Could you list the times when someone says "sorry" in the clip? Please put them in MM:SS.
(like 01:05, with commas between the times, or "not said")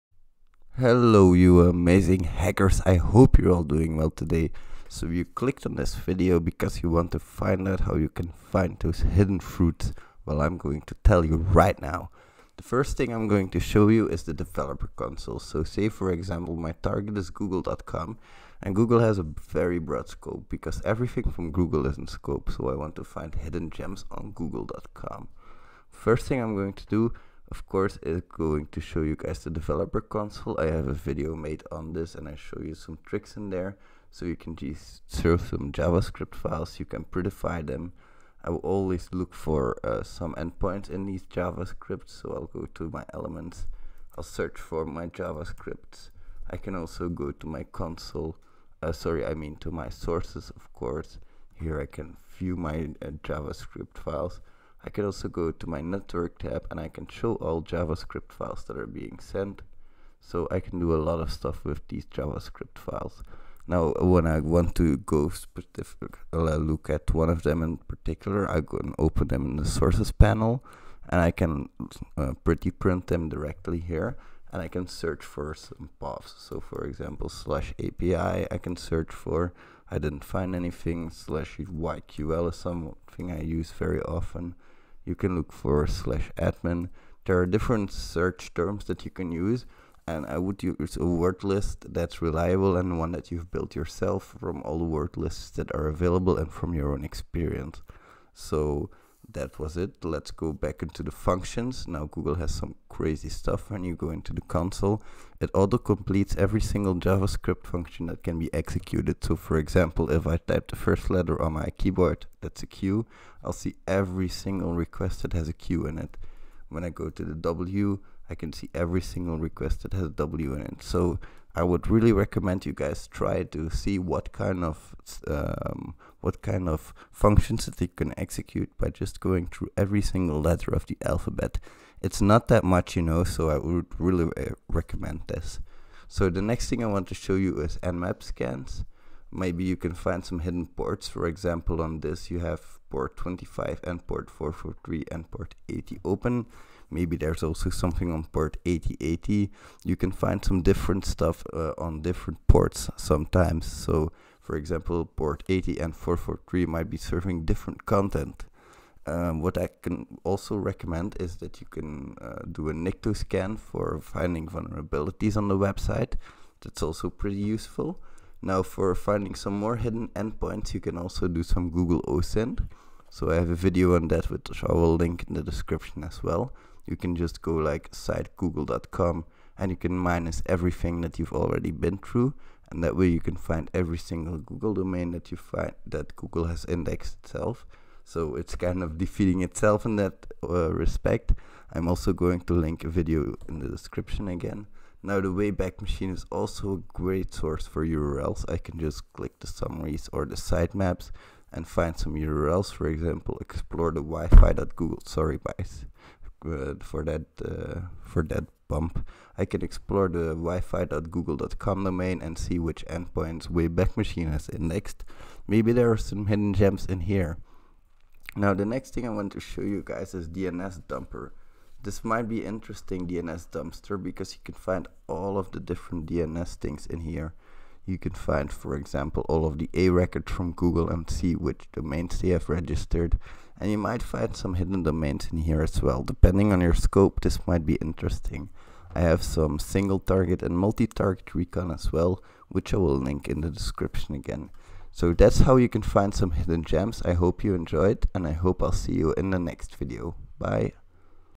00:48, 03:25.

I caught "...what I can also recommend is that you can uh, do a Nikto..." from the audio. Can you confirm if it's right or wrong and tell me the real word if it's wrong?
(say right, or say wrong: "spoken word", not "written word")
right.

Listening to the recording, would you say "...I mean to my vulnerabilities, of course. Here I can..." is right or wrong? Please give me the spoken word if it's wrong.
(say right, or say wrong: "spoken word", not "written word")
wrong: "sources", not "vulnerabilities".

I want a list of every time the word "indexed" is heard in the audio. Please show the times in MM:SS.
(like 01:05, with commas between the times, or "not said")
03:06, 03:34.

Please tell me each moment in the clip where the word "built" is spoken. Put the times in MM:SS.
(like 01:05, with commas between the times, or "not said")
01:33.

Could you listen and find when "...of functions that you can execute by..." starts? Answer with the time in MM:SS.
02:06.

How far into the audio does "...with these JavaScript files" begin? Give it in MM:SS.
01:01.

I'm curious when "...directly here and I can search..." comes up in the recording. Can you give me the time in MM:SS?
01:13.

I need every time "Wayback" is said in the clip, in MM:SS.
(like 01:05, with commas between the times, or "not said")
03:15, 03:33.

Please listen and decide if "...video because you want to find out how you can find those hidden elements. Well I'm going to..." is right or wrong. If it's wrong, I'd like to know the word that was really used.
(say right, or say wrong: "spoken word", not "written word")
wrong: "fruits", not "elements".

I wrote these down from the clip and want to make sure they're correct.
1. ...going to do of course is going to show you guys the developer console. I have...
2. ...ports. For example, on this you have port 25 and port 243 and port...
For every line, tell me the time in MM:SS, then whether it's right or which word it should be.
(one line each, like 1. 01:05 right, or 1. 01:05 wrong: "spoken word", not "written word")
1. 00:26 right
2. 02:20 wrong: "443", not "243".